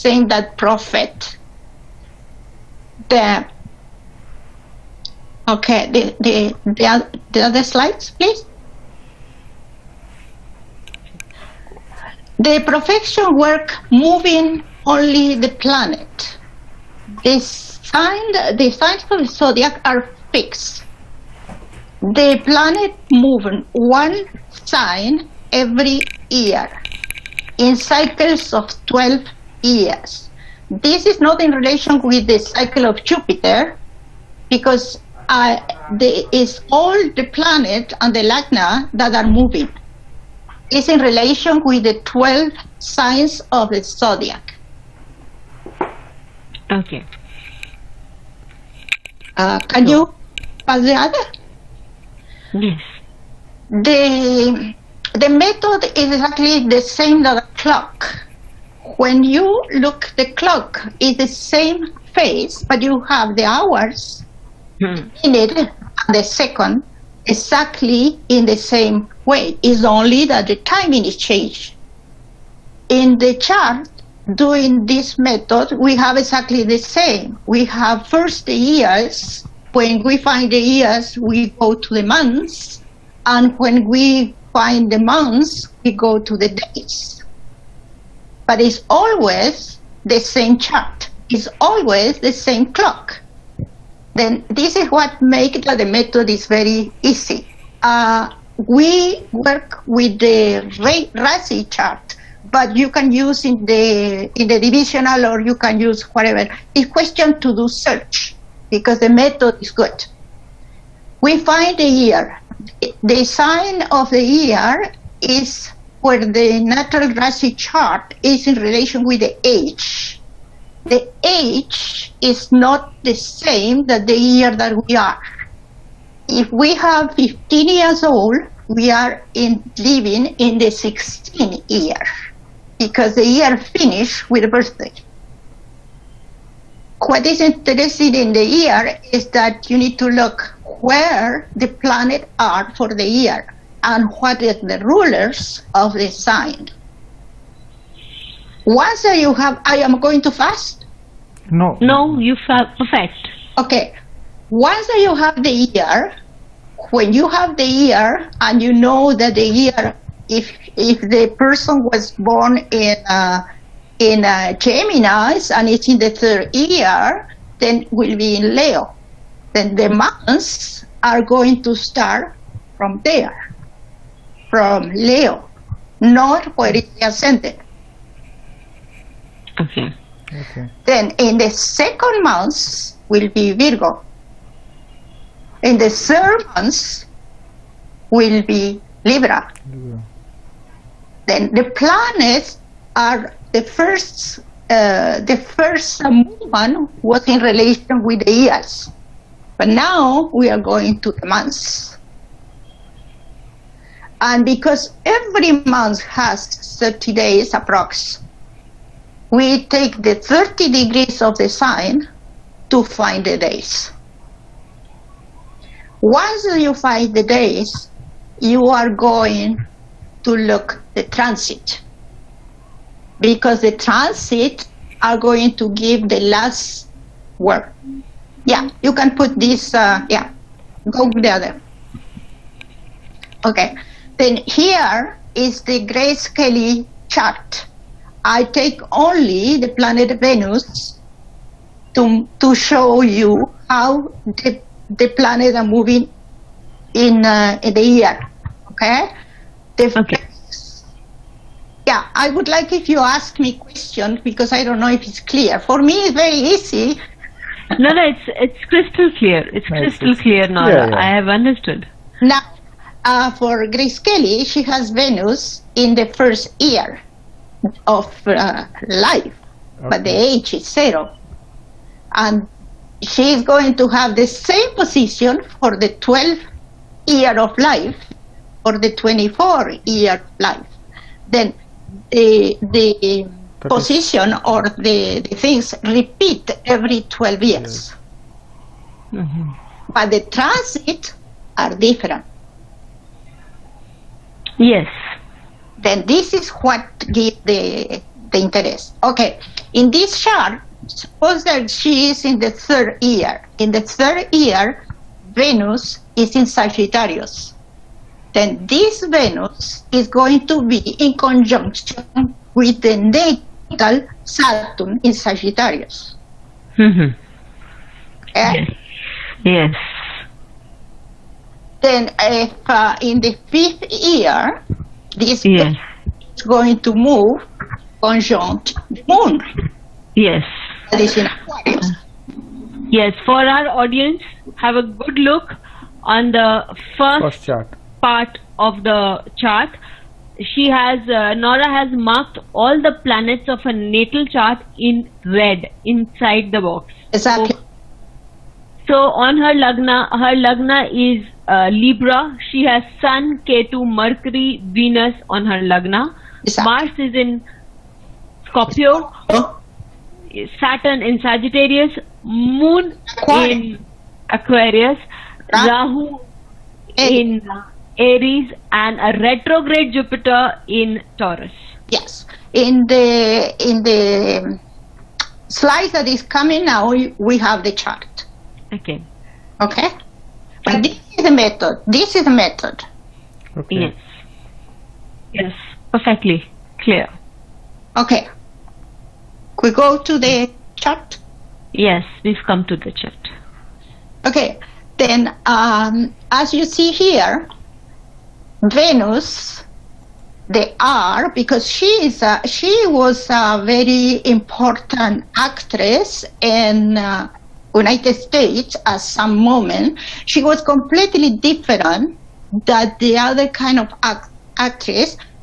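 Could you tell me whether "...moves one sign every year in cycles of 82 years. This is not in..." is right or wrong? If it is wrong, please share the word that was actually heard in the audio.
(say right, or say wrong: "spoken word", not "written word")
wrong: "12", not "82".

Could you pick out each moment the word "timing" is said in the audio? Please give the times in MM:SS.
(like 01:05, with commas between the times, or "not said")
01:10.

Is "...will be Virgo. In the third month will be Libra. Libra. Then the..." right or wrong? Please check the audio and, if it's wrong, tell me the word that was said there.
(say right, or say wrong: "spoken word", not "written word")
right.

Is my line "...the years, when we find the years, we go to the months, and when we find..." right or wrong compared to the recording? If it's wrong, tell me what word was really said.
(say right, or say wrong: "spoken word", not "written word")
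right.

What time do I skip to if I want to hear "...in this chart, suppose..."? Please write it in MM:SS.
04:59.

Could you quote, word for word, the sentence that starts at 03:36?
Once you find the days, you are going to look the transit because the transit are going to give the last word.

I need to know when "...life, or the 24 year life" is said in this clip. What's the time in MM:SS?
04:37.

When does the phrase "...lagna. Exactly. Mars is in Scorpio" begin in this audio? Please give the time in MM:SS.
05:55.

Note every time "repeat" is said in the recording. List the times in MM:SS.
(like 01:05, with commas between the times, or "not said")
04:45.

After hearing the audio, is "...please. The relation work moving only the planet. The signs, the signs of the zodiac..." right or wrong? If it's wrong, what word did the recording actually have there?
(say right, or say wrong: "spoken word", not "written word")
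wrong: "profection", not "relation".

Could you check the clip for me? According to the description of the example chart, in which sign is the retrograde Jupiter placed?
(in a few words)
Taurus.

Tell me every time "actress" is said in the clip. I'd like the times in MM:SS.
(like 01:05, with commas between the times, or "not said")
06:45, 06:54.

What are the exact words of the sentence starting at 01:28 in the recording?
But it's always the same chart.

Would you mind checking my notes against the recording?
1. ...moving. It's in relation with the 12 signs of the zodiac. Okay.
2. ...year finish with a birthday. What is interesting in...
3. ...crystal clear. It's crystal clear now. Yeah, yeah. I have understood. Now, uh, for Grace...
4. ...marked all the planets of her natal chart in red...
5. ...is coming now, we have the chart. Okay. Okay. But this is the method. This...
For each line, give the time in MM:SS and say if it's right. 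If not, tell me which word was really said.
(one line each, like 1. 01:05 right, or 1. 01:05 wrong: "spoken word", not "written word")
1. 00:39 right
2. 02:13 right
3. 04:18 right
4. 05:41 right
5. 06:16 right.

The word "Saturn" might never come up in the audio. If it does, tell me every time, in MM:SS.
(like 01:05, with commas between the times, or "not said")
05:14, 06:00.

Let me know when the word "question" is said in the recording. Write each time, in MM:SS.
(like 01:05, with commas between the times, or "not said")
01:46, 04:13.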